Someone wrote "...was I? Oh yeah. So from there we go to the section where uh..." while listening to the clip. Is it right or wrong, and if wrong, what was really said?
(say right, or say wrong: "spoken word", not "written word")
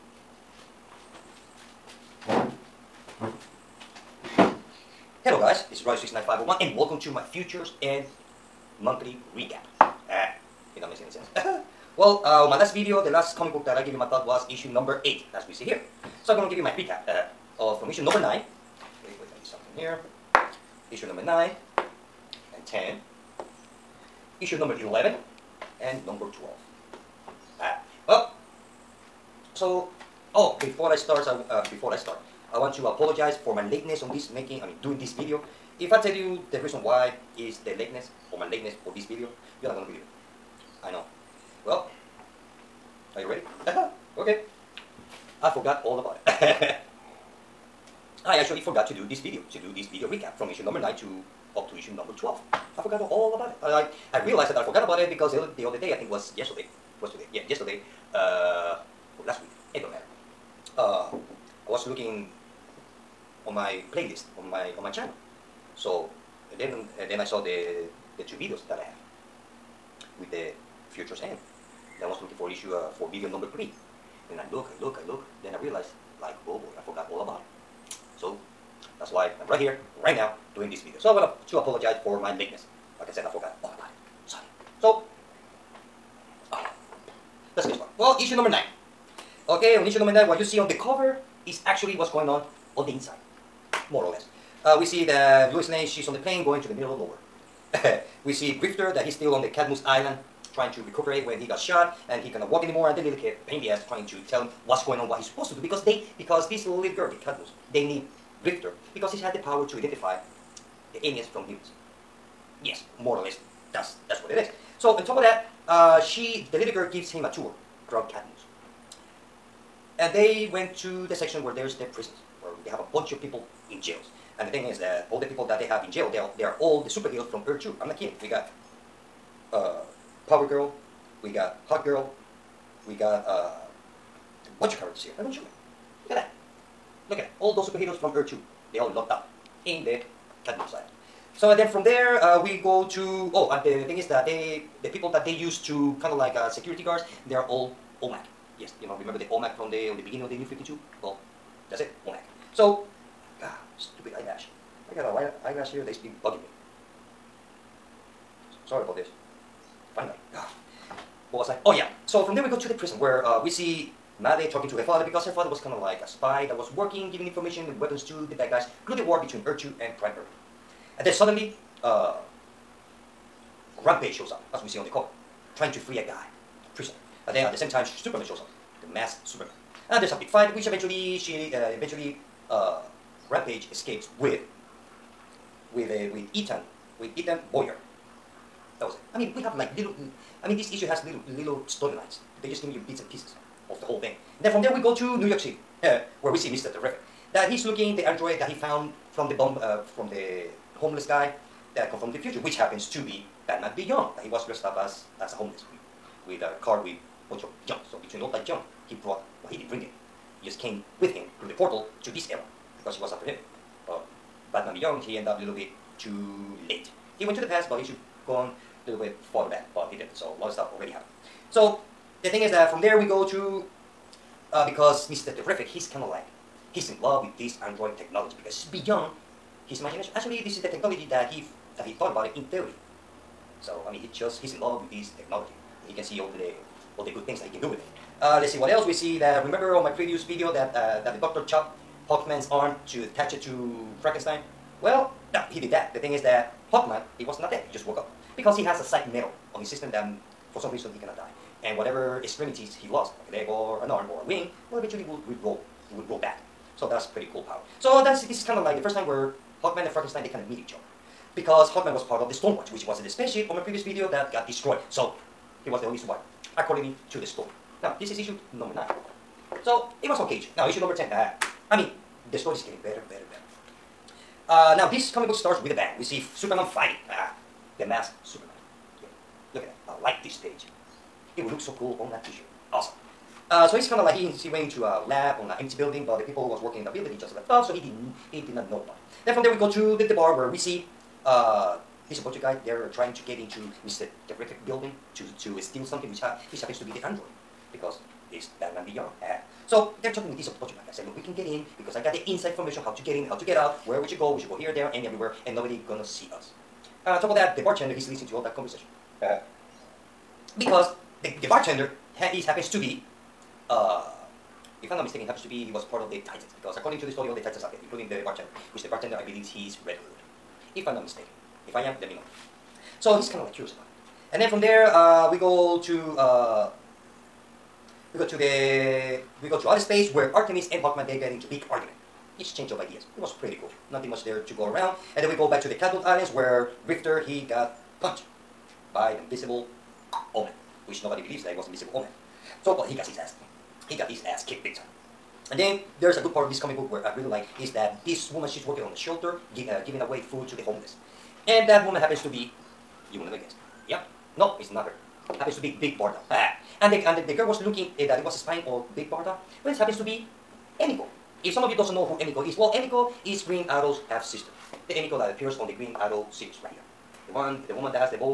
wrong: "prison", not "section".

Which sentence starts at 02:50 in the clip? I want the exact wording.
And then suddenly, uh, Rampage shows up, as we see on the cover, trying to free a guy, a prisoner.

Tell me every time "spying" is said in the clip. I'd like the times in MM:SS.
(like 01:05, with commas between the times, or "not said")
05:58.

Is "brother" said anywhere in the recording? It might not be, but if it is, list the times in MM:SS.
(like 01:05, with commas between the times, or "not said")
not said.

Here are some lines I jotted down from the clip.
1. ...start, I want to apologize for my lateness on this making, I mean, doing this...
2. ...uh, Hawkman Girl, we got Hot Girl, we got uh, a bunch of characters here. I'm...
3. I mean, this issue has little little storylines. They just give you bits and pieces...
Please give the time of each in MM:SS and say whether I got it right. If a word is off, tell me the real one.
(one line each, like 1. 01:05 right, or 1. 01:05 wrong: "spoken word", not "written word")
1. 00:31 right
2. 02:09 wrong: "Power", not "Hawkman"
3. 03:10 right.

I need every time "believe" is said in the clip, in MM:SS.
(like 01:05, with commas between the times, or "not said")
00:39, 05:19, 05:41.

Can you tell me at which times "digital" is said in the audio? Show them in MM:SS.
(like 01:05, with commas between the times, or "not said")
not said.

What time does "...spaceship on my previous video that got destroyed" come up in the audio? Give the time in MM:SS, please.
04:23.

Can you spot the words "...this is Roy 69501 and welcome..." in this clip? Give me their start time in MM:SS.
00:05.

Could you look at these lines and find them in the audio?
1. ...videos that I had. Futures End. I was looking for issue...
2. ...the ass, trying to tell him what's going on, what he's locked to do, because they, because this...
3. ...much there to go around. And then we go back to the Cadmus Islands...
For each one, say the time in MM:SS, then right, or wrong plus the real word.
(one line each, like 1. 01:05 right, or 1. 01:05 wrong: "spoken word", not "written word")
1. 01:08 right
2. 01:43 wrong: "supposed", not "locked"
3. 05:34 right.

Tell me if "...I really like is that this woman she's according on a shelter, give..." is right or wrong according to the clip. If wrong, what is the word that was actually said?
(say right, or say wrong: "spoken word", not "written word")
wrong: "working", not "according".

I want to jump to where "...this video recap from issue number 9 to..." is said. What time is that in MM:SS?
00:49.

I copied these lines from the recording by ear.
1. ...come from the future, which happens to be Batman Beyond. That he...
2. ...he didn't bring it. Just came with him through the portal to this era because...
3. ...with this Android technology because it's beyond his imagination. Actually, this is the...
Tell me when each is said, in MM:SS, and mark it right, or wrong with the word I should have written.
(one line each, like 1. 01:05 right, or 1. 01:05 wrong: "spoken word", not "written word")
1. 03:21 right
2. 03:29 right
3. 03:47 right.